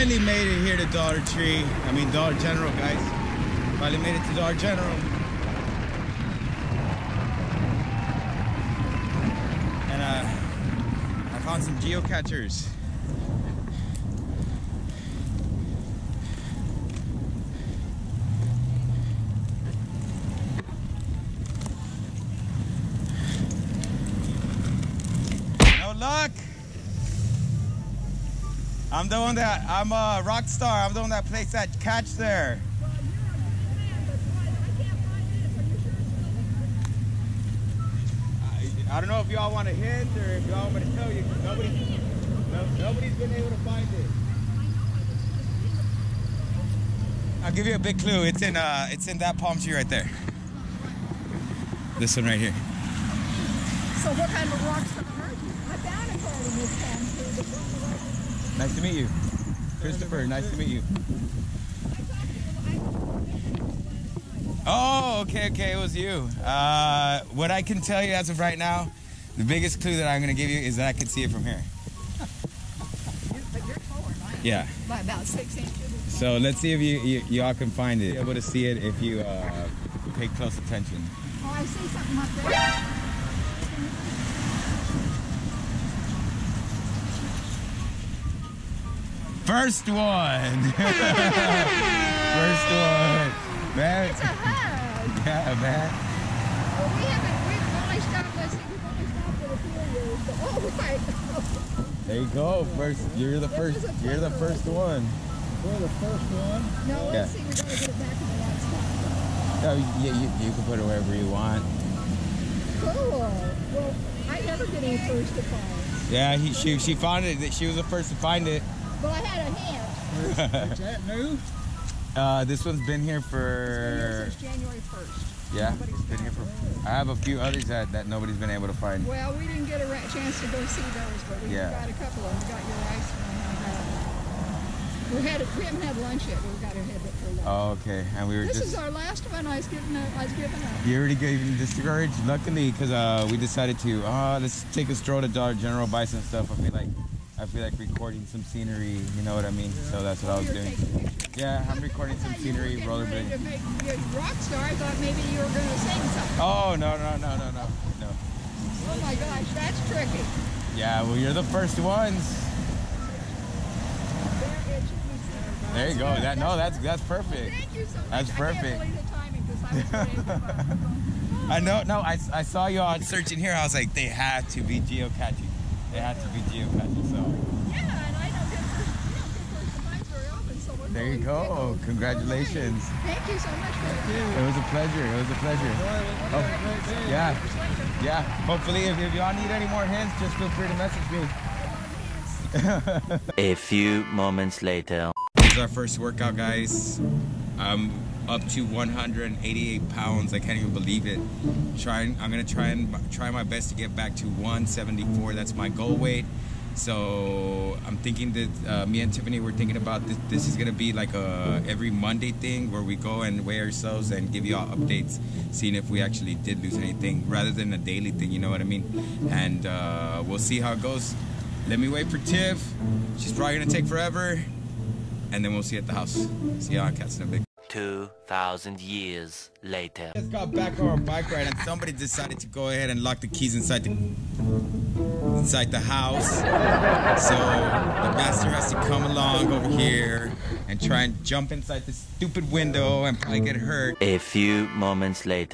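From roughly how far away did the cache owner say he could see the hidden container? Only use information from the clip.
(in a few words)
6 inches.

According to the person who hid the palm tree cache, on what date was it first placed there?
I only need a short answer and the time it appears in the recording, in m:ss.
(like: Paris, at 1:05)
January 1st, at 2:04.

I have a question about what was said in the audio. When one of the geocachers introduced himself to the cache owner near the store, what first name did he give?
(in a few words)
Christopher.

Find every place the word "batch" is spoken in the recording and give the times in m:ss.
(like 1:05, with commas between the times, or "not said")
not said.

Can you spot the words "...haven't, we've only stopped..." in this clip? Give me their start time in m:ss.
1:37.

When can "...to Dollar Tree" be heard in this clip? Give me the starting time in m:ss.
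0:00.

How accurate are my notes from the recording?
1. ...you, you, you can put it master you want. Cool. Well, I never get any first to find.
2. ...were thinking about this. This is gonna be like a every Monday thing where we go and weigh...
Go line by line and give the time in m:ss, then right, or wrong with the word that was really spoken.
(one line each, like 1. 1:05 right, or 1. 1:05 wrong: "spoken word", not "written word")
1. 1:49 wrong: "wherever", not "master"
2. 3:29 right.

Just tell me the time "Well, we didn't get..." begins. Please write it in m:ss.
2:09.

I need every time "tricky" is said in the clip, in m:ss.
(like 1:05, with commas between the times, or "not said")
2:39.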